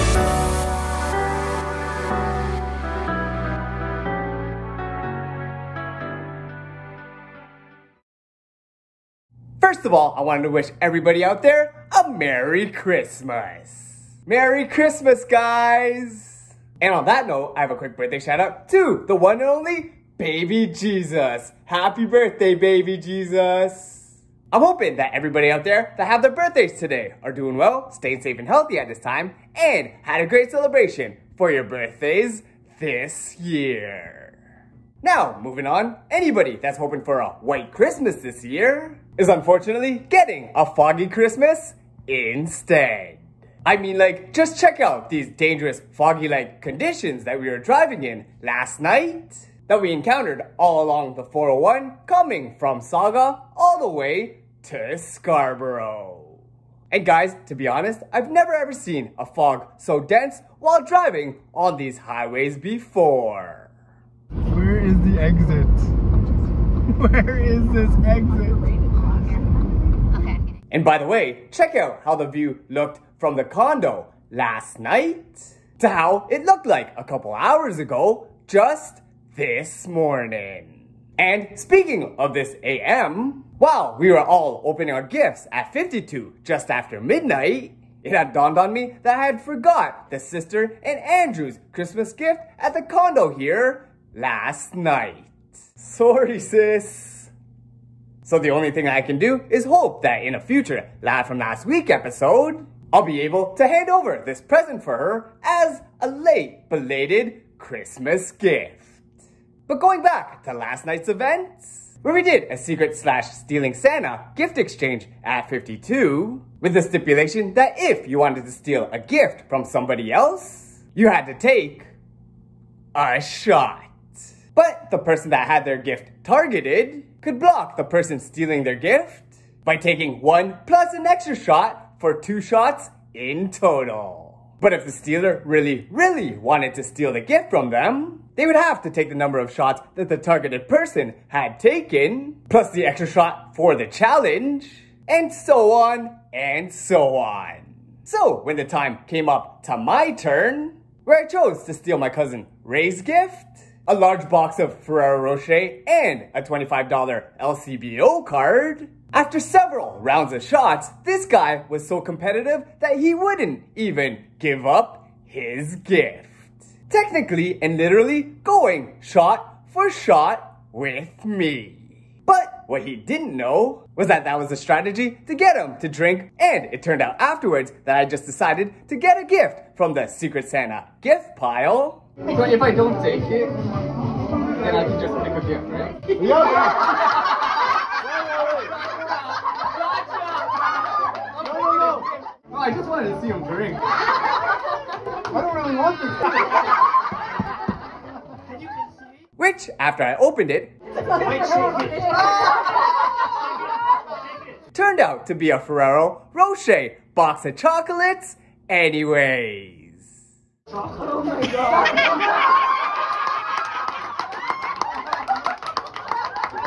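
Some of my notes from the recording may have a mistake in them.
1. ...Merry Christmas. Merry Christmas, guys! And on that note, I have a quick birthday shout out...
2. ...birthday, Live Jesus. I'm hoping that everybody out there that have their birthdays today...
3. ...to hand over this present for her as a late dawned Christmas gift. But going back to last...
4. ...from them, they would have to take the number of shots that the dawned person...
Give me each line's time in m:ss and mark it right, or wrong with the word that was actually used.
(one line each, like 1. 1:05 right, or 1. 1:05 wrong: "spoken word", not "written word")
1. 0:12 right
2. 0:22 wrong: "Baby", not "Live"
3. 1:43 wrong: "belated", not "dawned"
4. 2:17 wrong: "targeted", not "dawned".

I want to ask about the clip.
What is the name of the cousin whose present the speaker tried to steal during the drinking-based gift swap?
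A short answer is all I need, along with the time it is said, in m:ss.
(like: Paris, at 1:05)
Ray, at 2:32.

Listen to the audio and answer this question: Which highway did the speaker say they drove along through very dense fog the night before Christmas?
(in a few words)
401.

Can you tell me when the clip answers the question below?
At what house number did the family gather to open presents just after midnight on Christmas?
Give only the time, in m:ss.
1:25.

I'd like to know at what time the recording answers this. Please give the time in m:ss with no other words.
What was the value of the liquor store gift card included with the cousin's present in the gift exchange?
2:36.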